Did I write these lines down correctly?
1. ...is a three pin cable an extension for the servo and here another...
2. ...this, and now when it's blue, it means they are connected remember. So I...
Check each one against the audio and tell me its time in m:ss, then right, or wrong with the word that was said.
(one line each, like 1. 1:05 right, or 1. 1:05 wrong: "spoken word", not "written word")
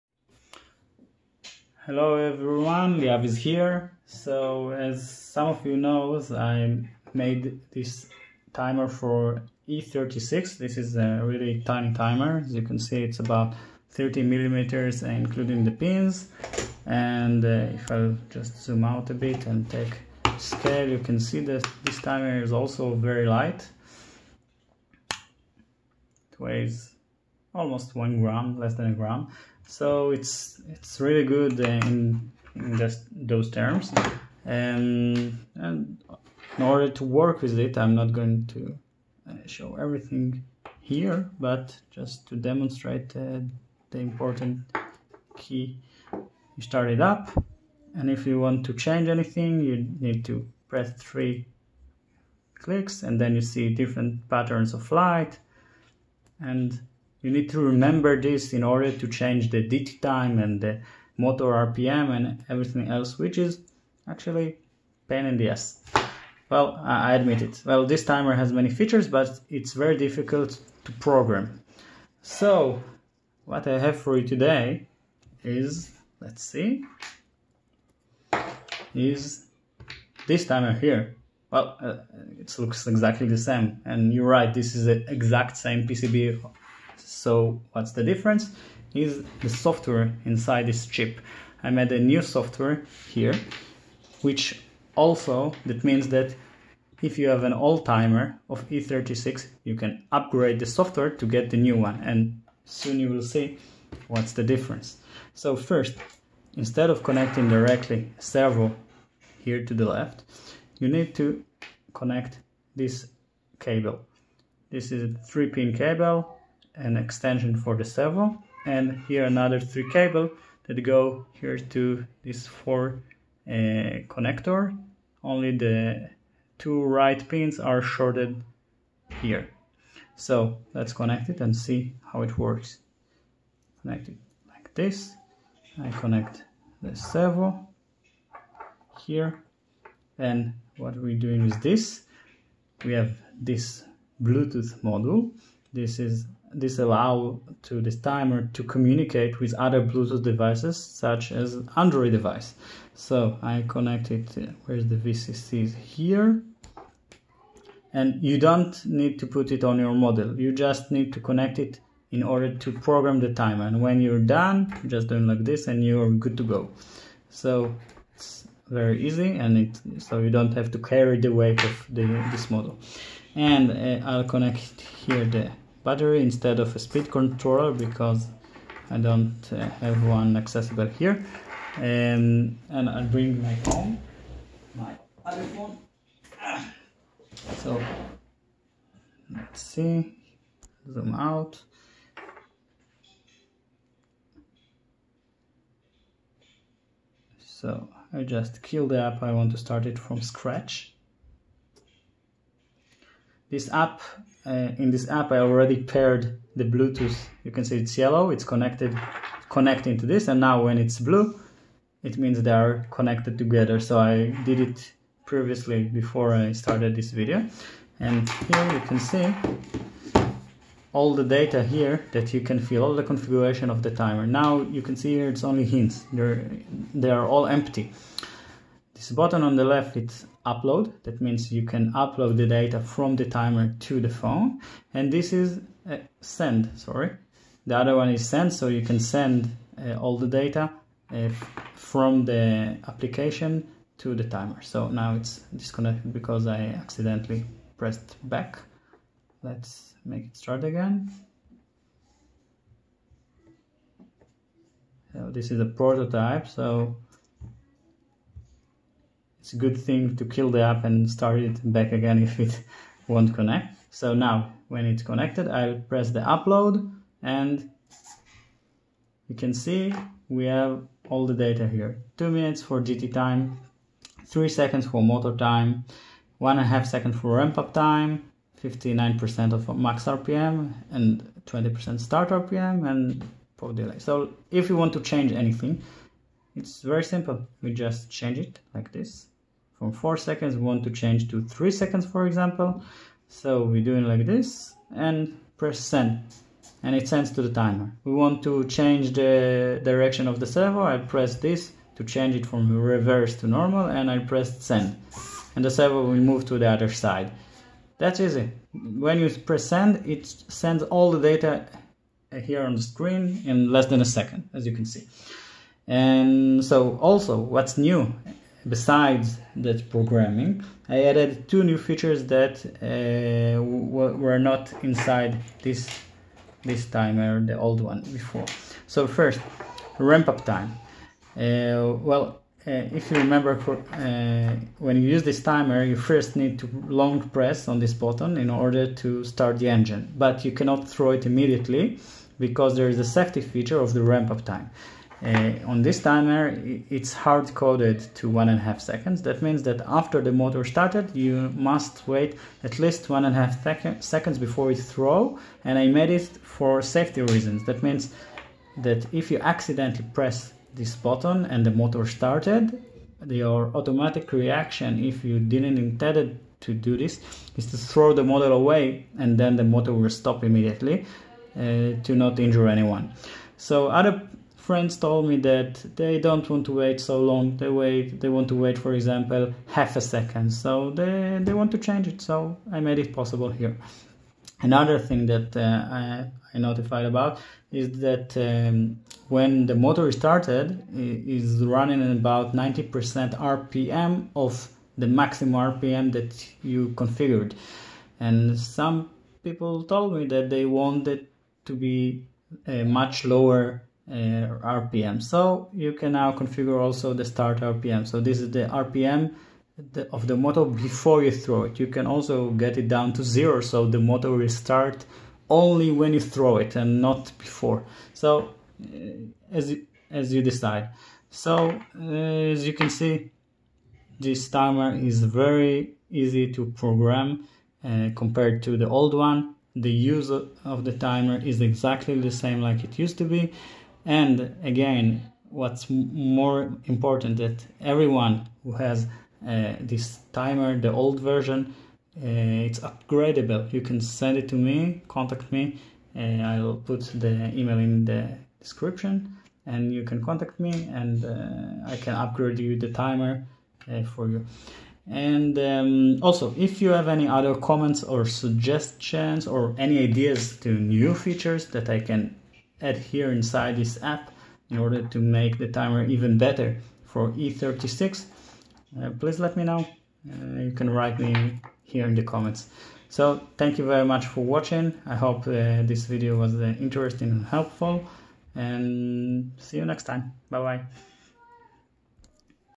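1. 1:54 right
2. 3:30 wrong: "together", not "remember".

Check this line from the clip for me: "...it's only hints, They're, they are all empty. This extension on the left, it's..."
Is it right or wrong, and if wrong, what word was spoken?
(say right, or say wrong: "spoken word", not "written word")
wrong: "button", not "extension".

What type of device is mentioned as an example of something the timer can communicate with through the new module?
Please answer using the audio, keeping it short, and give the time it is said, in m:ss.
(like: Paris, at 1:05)
Android device, at 2:31.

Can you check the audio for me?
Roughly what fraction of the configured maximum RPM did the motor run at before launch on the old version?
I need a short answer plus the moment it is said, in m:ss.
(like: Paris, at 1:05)
90%, at 6:32.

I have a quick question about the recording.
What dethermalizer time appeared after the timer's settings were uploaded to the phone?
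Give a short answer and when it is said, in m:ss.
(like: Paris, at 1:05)
2 minutes, at 4:32.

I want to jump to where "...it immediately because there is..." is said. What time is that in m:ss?
5:41.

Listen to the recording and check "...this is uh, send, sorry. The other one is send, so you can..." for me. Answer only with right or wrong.
right.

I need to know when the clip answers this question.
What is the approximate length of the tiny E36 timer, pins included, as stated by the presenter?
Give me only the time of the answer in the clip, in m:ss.
0:13.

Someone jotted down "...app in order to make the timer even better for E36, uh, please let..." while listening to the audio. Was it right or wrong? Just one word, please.
right.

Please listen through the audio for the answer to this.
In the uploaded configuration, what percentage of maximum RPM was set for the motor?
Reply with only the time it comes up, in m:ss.
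4:38.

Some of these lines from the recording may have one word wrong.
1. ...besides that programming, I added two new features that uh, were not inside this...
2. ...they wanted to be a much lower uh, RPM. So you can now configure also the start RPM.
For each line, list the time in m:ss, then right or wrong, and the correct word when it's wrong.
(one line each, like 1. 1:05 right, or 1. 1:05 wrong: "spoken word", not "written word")
1. 5:18 right
2. 6:40 right.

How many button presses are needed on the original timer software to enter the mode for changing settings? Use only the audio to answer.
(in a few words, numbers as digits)
3 clicks.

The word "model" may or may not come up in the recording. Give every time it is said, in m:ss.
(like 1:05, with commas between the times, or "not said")
2:39, 2:52, 6:08.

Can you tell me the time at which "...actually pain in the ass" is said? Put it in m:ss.
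1:04.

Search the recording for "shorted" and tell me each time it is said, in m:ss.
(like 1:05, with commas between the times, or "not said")
2:07.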